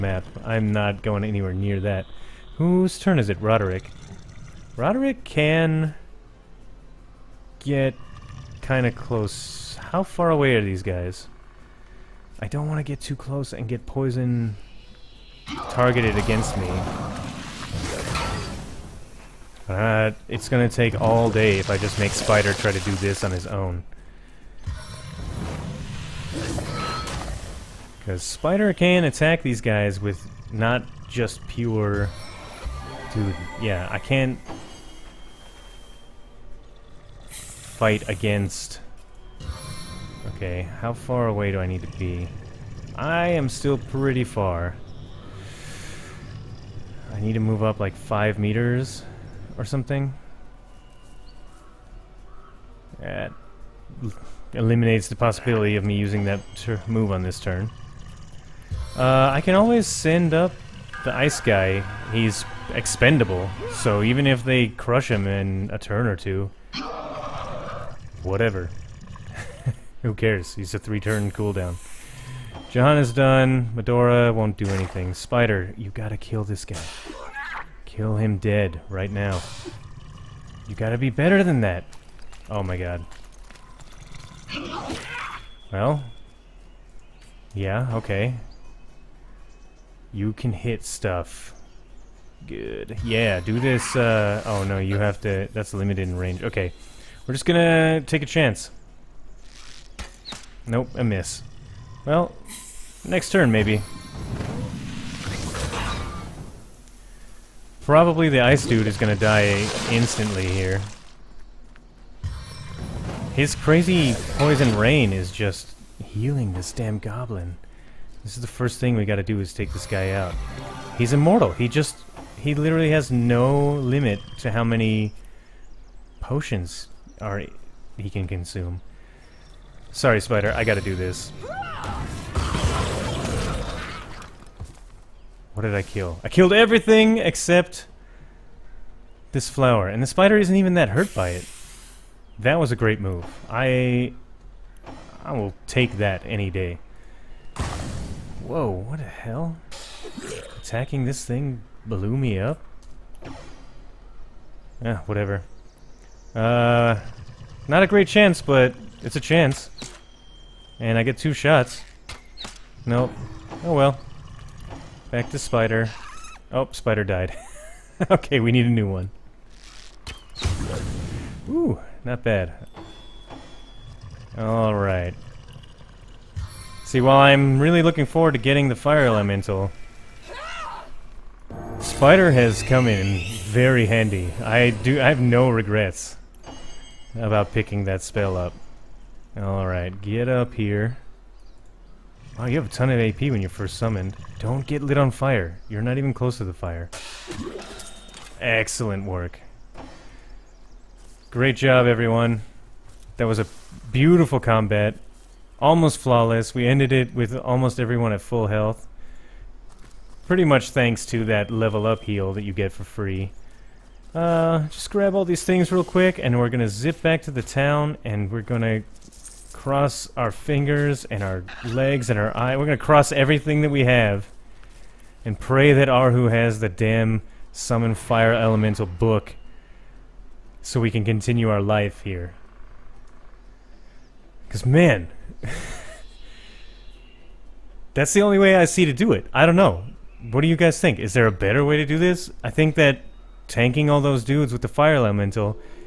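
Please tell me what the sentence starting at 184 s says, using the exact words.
I do I have no regrets about picking that spell up.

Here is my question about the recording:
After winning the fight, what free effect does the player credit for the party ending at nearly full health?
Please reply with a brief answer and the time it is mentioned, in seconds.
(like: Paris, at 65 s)
level up heal, at 211 s.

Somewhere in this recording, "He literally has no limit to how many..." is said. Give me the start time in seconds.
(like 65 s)
122 s.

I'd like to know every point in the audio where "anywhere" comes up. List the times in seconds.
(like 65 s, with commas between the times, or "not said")
1 s.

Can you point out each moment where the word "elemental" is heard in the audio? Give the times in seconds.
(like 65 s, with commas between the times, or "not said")
179 s, 228 s, 244 s.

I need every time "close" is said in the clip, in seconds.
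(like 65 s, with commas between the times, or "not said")
8 s, 13 s, 196 s.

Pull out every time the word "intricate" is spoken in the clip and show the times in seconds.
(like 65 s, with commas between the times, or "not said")
not said.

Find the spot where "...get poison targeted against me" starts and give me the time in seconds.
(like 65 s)
13 s.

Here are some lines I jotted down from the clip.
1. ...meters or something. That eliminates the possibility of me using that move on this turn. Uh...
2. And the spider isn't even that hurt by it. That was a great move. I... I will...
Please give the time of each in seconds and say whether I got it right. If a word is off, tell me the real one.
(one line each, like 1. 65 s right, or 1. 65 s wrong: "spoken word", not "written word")
1. 48 s right
2. 139 s right.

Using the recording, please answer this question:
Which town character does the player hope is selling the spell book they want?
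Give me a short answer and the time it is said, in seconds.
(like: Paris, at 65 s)
Arhu, at 225 s.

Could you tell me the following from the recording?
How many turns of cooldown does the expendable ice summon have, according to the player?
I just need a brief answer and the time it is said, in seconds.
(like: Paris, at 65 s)
3, at 70 s.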